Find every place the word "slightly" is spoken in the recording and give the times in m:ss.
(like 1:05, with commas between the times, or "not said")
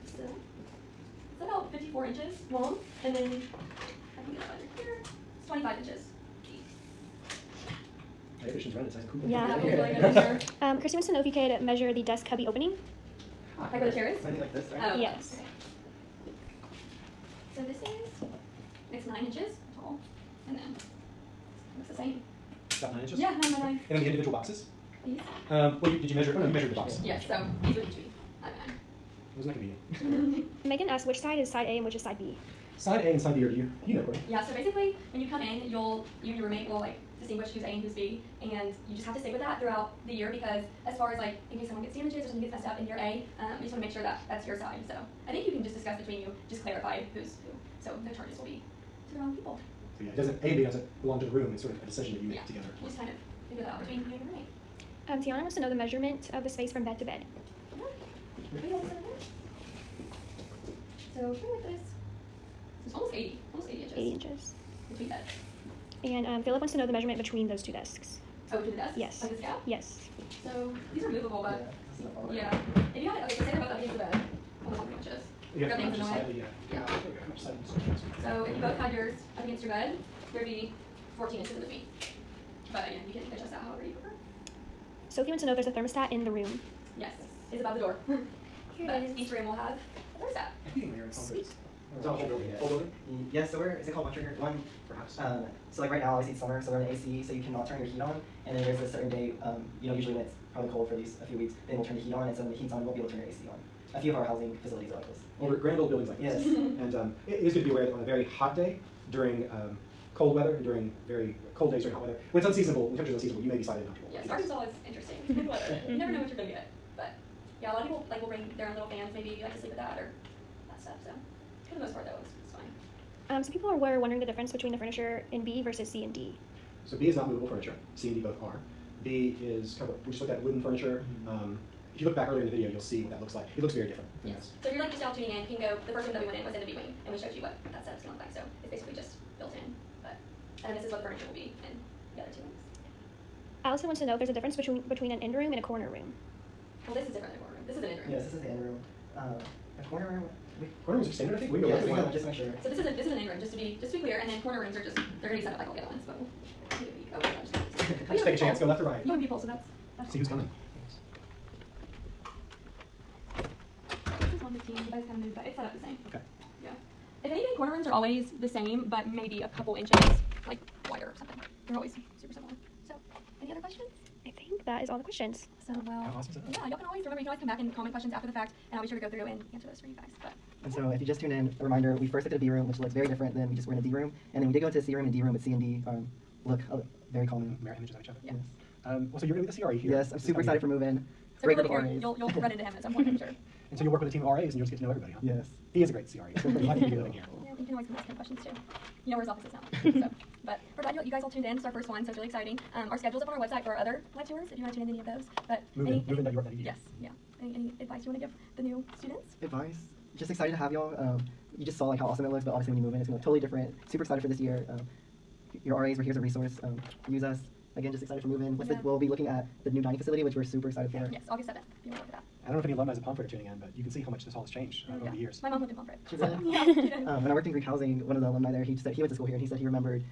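1:16, 1:53.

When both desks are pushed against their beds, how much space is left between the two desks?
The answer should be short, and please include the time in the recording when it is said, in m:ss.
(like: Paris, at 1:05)
14 inches, at 1:21.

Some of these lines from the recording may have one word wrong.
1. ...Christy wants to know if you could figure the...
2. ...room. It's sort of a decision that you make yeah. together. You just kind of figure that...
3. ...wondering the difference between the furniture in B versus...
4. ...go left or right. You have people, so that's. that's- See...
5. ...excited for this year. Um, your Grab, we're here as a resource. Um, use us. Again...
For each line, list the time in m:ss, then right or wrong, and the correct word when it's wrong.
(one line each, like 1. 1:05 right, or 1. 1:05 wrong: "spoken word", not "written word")
1. 0:10 wrong: "measure", not "figure"
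2. 0:51 right
3. 2:03 right
4. 2:38 right
5. 3:34 wrong: "RAs", not "Grab".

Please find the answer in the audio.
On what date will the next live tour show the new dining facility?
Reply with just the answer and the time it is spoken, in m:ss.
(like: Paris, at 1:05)
August 7, at 3:41.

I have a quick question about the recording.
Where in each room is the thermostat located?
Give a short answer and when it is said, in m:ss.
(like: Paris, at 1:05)
Above the door, at 1:27.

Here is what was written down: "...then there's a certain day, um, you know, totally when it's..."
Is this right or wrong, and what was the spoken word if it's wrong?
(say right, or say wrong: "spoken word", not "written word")
wrong: "usually", not "totally".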